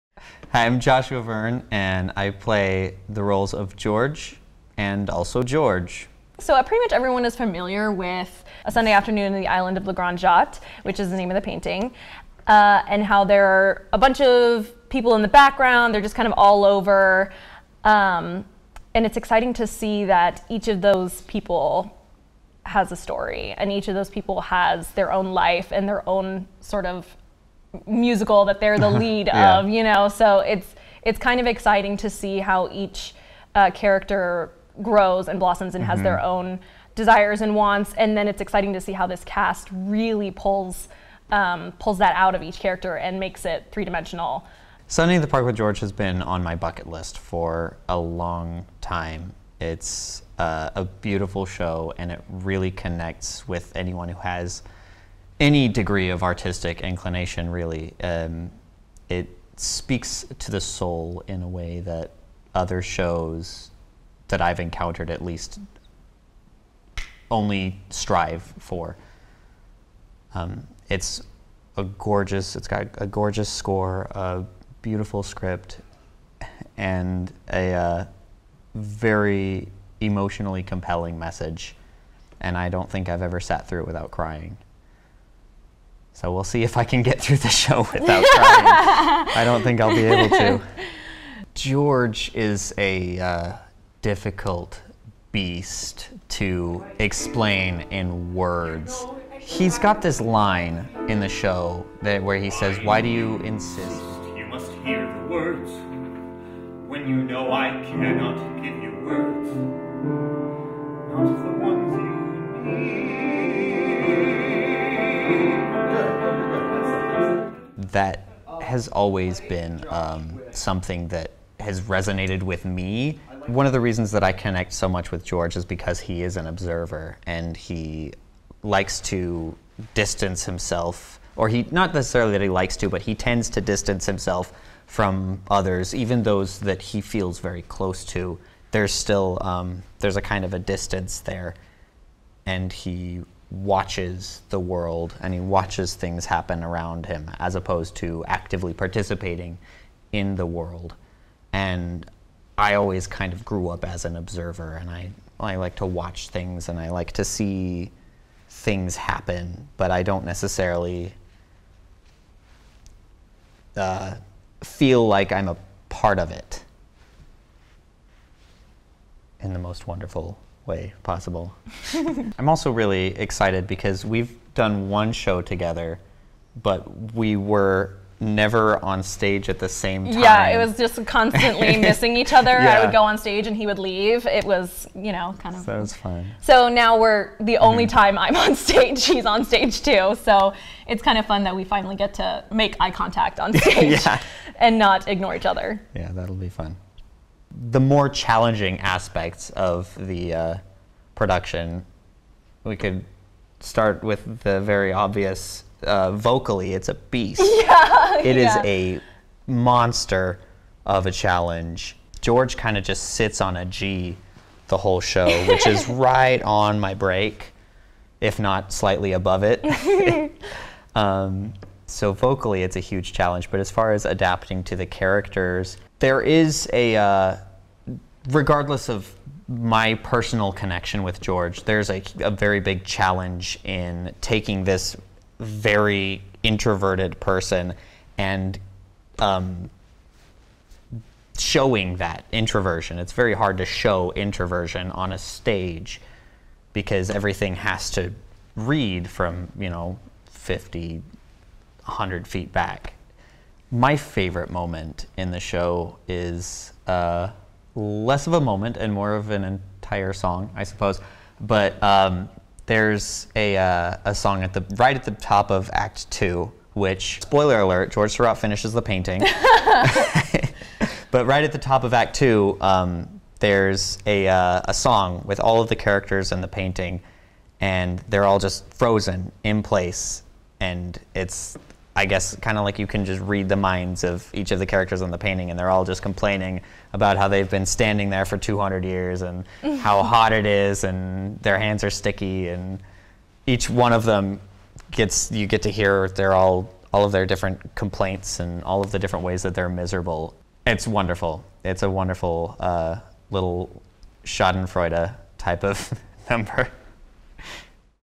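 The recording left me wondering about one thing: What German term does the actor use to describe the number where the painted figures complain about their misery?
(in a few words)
Schadenfreude.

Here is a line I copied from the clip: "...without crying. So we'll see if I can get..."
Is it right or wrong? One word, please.
right.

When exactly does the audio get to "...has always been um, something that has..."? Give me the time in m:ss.
1:58.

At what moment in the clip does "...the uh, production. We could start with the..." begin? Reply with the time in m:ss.
3:20.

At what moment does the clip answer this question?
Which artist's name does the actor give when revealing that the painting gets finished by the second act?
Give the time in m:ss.
4:27.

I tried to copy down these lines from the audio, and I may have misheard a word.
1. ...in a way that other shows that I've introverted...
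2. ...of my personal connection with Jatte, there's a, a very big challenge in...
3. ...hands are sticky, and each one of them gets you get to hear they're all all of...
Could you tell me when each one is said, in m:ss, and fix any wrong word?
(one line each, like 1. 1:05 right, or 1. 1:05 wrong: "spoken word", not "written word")
1. 1:01 wrong: "encountered", not "introverted"
2. 3:48 wrong: "George", not "Jatte"
3. 4:51 right.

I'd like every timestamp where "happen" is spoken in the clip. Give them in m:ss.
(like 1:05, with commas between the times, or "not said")
2:26, 2:38.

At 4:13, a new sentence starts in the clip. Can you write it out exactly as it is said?
My favorite moment in the show is uh, less of a moment and more of an entire song, I suppose.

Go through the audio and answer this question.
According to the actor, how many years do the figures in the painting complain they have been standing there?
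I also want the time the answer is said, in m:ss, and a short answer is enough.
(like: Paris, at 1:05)
200, at 4:48.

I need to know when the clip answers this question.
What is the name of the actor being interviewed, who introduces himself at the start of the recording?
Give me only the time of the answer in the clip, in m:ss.
0:00.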